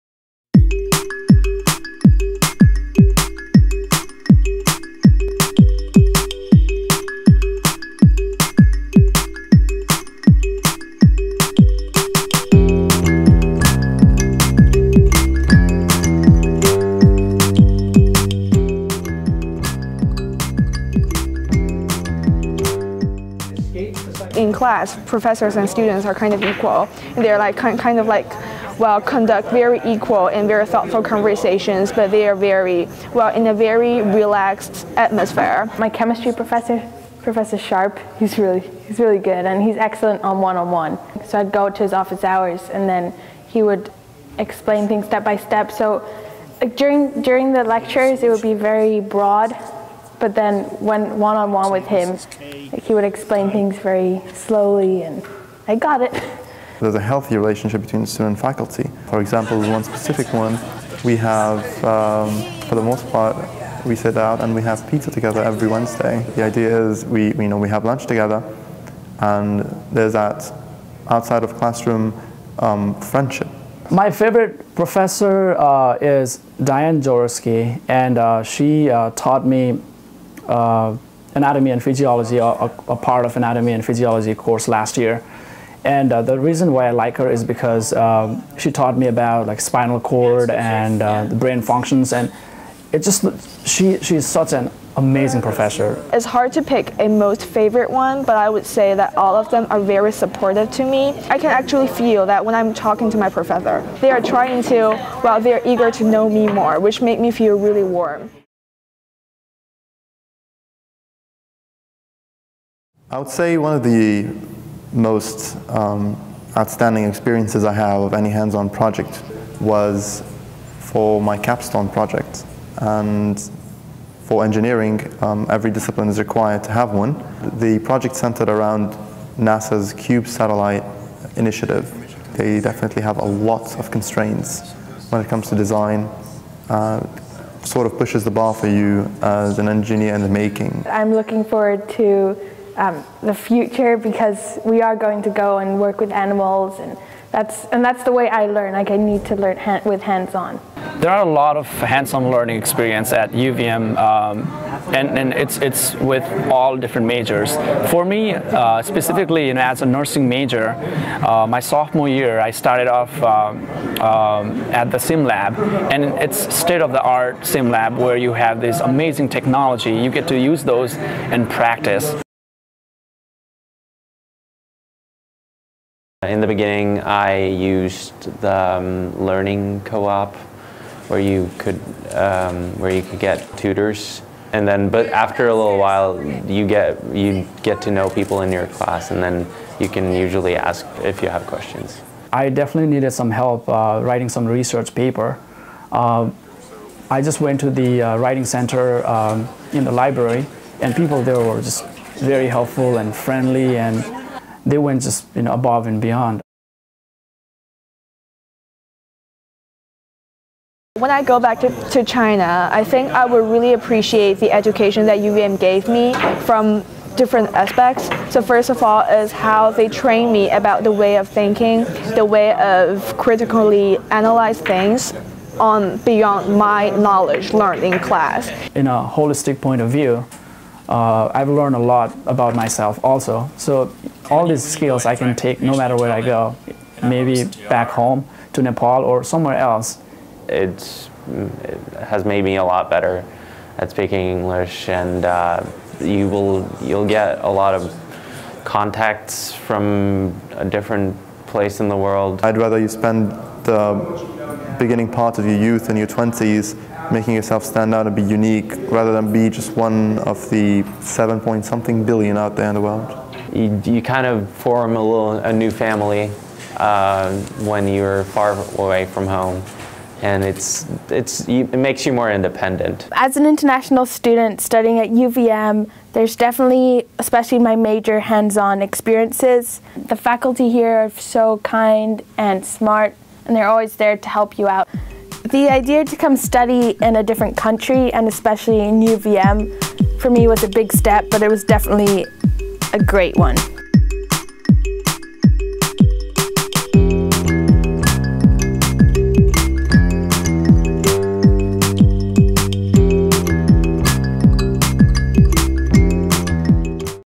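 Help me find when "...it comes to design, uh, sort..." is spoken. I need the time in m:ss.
2:15.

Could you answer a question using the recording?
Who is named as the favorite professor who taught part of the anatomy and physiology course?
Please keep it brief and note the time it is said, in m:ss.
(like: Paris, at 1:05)
Diane Jaworski, at 1:16.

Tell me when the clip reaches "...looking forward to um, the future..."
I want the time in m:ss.
2:21.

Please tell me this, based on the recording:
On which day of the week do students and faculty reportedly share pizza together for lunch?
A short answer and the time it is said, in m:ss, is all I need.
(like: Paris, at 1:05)
Wednesday, at 1:05.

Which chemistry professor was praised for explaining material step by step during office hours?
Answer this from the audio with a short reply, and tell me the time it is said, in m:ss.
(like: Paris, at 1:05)
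Professor Sharp, at 0:37.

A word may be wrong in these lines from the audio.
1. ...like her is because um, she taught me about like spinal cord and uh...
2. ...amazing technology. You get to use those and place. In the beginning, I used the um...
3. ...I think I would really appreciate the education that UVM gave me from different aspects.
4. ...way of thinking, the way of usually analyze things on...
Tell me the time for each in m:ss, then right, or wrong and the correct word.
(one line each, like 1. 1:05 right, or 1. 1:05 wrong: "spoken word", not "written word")
1. 1:26 right
2. 2:48 wrong: "practice", not "place"
3. 3:32 right
4. 3:40 wrong: "critically", not "usually".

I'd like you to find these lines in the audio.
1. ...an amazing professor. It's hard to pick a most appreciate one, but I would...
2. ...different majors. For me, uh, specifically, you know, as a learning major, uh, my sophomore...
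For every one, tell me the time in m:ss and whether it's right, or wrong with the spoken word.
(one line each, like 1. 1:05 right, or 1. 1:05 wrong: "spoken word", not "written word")
1. 1:34 wrong: "favorite", not "appreciate"
2. 2:36 wrong: "nursing", not "learning".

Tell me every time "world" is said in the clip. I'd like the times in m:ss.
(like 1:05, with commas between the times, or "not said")
4:11, 4:22.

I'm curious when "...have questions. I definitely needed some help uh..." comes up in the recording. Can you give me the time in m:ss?
3:11.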